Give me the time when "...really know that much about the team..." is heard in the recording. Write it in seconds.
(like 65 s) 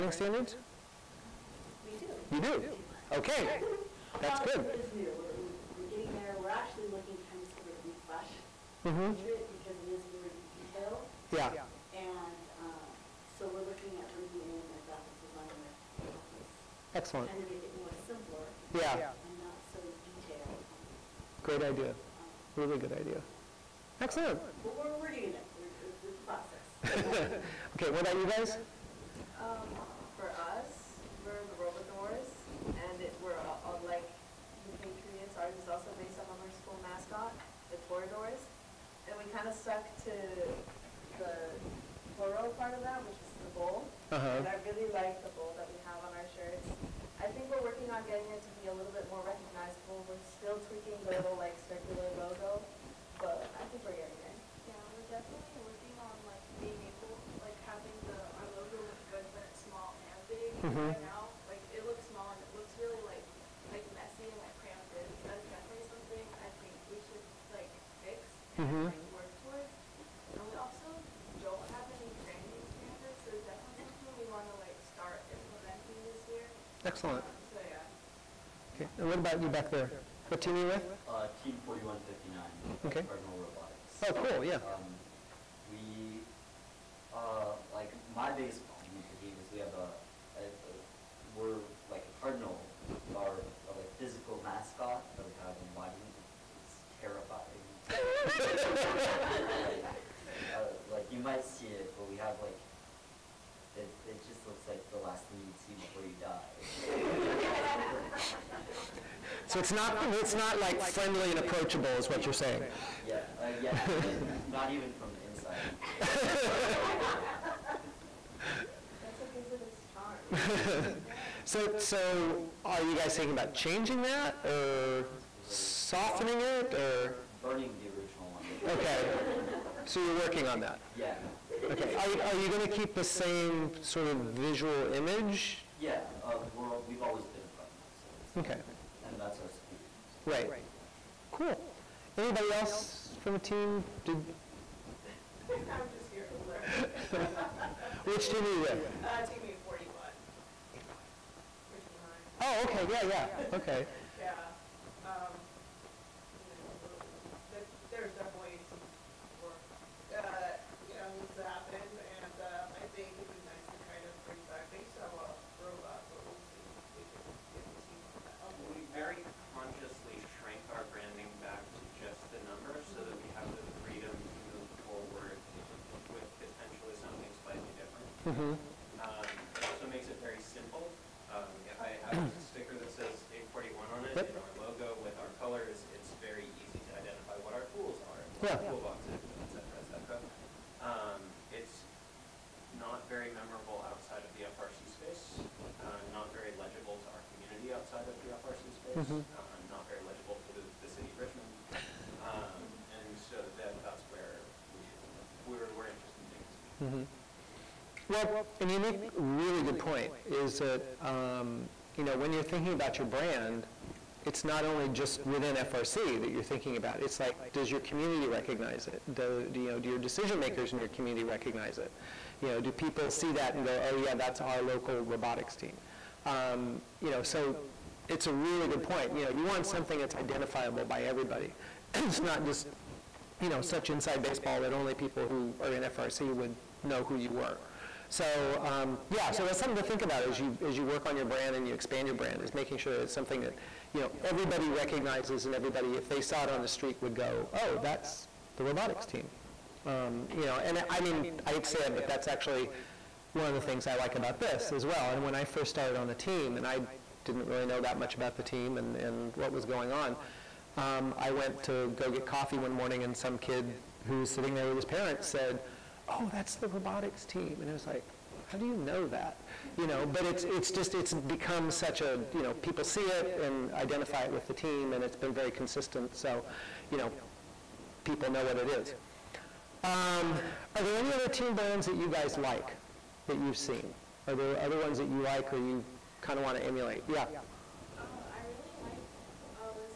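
257 s.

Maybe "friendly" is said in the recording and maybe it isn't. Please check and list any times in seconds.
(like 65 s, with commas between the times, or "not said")
110 s.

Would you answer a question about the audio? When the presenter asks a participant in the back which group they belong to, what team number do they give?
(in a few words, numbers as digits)
4159.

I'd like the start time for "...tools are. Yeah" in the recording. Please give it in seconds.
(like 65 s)
187 s.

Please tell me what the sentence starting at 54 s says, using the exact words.
Yeah, we're definitely working on like being able like having the our logo look good but it's small and big.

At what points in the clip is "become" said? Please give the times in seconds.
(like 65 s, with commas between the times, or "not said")
271 s.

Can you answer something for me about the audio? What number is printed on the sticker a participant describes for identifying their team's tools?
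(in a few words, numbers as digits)
841.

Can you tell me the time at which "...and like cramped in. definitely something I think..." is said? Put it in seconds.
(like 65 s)
64 s.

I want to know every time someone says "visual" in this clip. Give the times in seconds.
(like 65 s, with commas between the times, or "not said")
134 s.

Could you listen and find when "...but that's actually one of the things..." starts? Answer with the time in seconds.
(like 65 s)
251 s.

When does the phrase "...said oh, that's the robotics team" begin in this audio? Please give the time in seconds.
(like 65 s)
265 s.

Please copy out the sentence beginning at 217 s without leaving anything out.
It's like, does your community recognize it?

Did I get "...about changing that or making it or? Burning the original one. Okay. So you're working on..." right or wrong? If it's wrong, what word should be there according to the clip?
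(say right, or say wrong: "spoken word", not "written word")
wrong: "softening", not "making".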